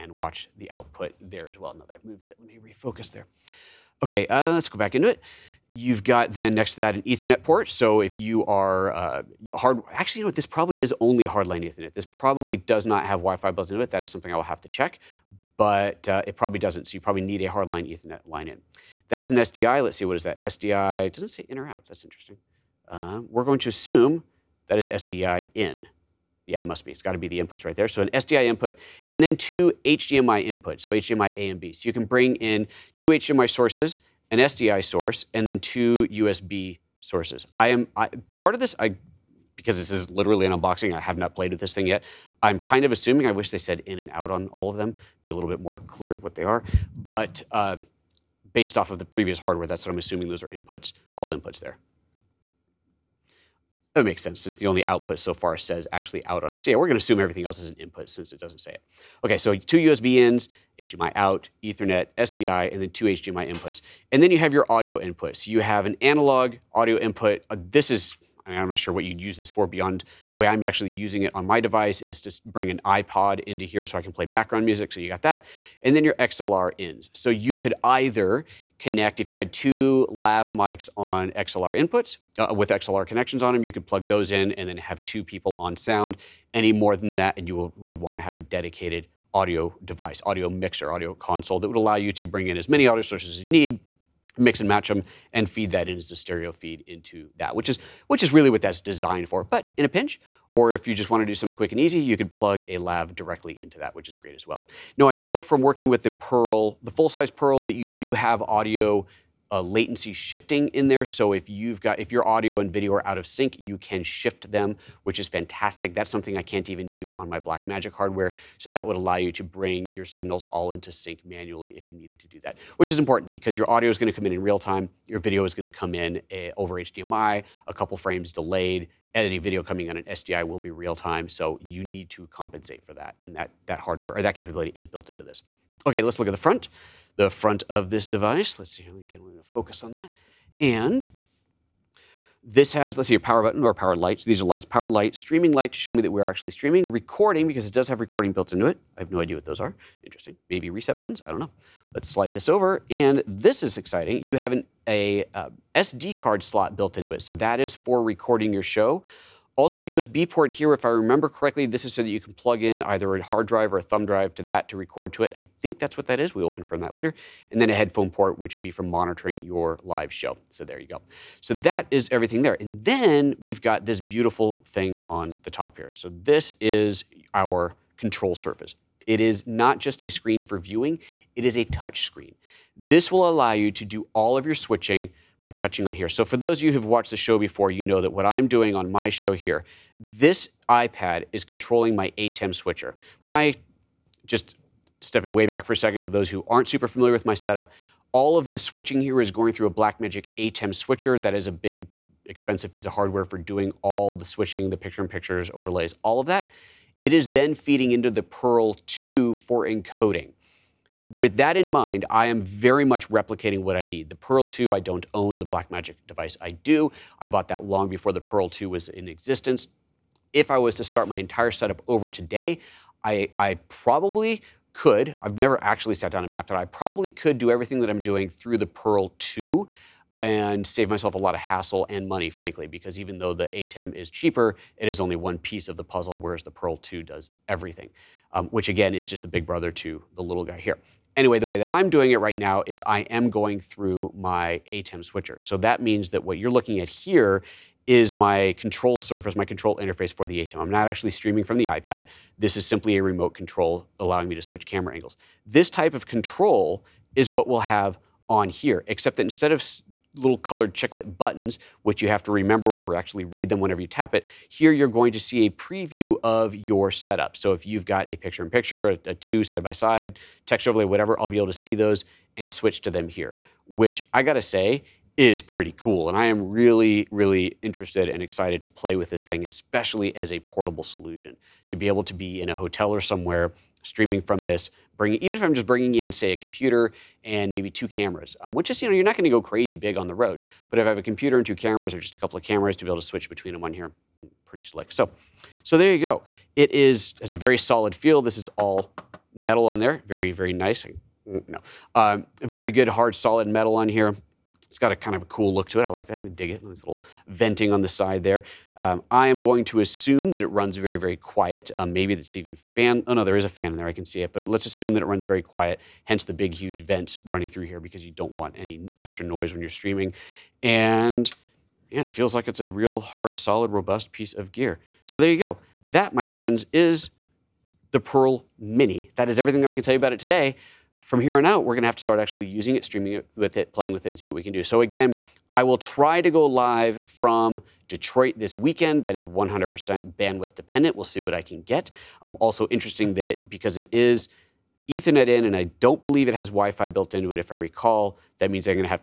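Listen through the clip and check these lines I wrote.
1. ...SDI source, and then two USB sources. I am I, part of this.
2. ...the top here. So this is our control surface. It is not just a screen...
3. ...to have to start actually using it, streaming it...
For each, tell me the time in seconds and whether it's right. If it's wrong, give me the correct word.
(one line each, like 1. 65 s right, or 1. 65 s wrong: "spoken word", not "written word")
1. 34 s right
2. 175 s right
3. 331 s right.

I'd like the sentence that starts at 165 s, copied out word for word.
I think that's what that is.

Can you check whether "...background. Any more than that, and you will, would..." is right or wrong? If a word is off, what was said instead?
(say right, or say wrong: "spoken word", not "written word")
wrong: "sound", not "background".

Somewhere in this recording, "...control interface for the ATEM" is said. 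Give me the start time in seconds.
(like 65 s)
249 s.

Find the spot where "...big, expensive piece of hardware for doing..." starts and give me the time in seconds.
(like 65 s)
201 s.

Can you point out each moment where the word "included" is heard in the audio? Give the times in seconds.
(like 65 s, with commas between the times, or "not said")
not said.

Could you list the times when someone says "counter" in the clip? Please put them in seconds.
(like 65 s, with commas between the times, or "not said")
not said.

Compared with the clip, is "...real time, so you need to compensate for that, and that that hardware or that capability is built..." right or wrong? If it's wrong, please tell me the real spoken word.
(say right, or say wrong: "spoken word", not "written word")
right.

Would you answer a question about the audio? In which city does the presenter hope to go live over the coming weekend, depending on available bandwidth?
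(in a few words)
Detroit.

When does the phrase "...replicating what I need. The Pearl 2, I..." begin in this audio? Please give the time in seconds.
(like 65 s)
213 s.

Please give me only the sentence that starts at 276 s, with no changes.
And I am really, really interested and excited to play with this thing, especially as a portable solution.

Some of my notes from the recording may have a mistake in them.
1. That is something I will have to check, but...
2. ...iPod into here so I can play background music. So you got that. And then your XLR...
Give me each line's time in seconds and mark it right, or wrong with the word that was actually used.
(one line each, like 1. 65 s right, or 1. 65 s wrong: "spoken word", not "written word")
1. 13 s right
2. 72 s right.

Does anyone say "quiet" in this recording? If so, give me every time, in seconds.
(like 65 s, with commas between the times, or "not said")
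311 s, 315 s.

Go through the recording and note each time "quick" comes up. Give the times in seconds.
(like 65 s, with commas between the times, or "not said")
101 s.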